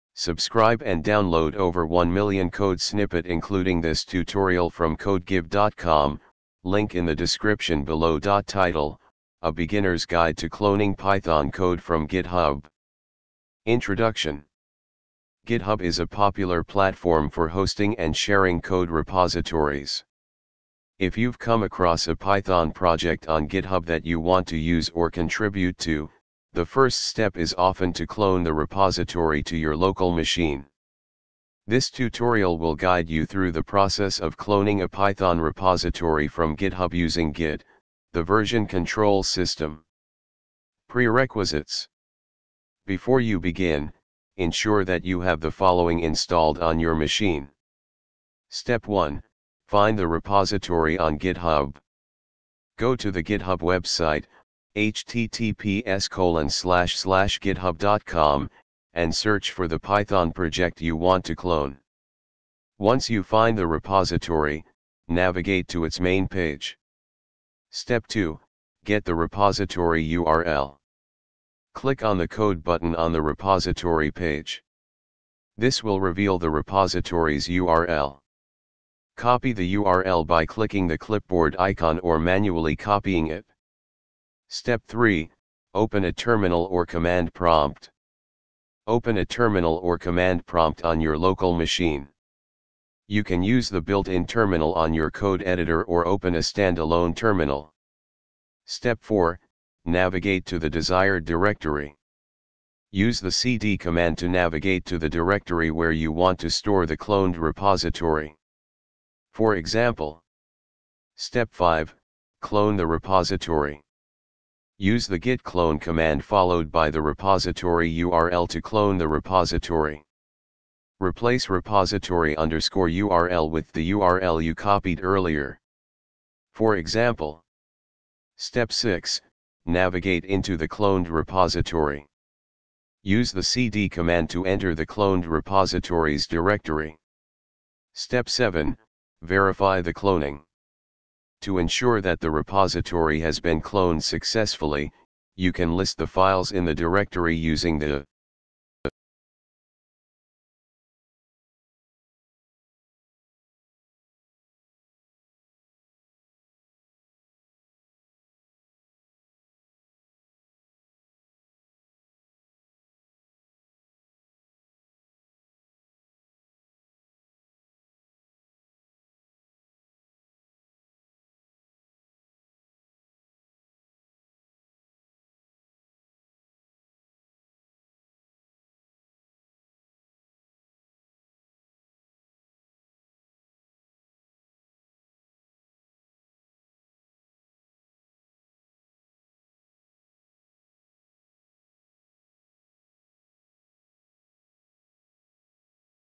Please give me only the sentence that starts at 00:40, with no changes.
Prerequisites Before you begin, ensure that you have the following installed on your machine.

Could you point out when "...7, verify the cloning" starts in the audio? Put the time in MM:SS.
02:18.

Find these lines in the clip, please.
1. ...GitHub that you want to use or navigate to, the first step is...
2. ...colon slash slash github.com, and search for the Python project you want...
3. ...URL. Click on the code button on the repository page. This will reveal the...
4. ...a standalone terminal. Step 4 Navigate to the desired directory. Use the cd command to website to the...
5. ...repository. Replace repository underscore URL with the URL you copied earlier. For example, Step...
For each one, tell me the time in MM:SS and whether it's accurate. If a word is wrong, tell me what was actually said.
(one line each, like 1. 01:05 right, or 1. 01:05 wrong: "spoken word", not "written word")
1. 00:23 wrong: "contribute", not "navigate"
2. 00:56 right
3. 01:10 right
4. 01:36 wrong: "navigate", not "website"
5. 01:59 right.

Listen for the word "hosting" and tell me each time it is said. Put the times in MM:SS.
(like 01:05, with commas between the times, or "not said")
00:17.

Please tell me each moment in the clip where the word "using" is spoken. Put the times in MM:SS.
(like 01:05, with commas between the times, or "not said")
00:36, 02:27.